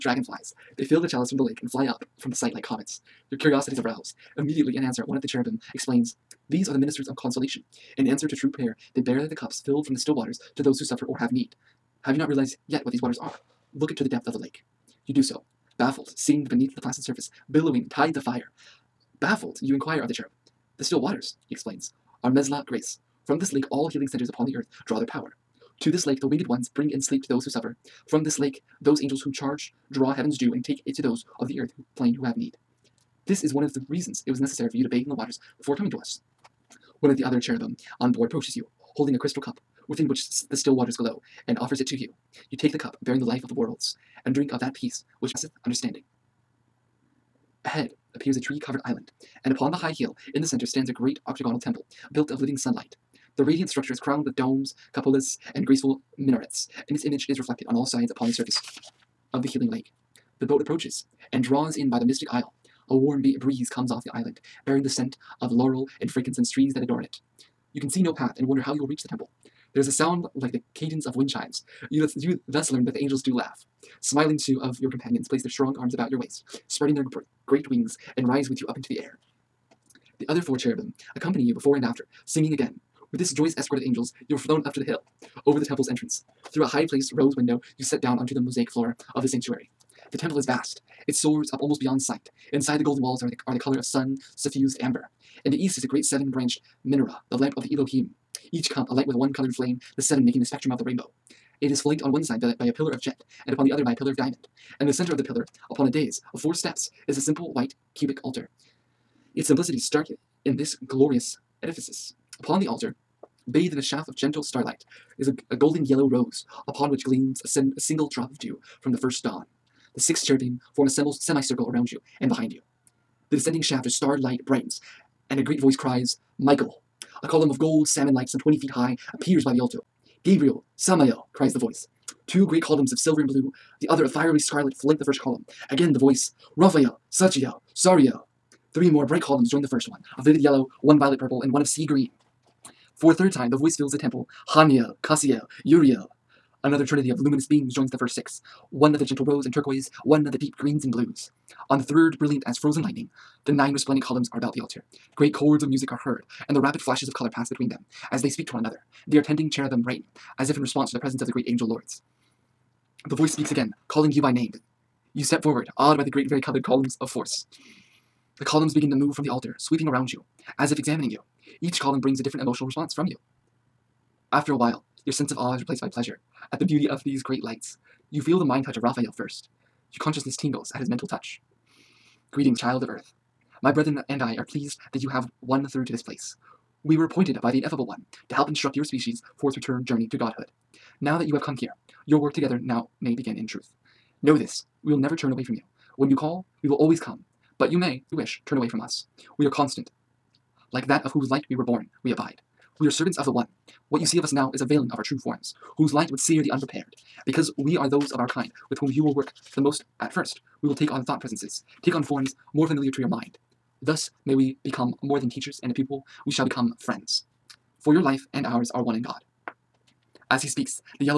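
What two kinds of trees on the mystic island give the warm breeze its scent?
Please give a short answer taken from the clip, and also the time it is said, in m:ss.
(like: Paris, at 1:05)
laurel and frankincense, at 1:05.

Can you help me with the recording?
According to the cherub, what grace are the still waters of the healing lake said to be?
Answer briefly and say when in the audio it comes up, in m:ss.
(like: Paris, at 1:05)
Mesla grace, at 0:22.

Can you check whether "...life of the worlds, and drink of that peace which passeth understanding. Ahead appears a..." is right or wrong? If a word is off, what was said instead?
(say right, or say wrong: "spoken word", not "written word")
right.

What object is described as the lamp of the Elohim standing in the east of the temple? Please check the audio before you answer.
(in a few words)
seven-branched menorah.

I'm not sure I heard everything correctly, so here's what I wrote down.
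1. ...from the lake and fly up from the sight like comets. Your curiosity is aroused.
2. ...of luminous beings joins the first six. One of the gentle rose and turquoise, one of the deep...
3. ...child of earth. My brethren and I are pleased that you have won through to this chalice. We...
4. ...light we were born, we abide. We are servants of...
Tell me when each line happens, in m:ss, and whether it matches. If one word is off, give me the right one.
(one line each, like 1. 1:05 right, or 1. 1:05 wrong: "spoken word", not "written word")
1. 0:01 right
2. 2:27 right
3. 3:02 wrong: "place", not "chalice"
4. 3:21 right.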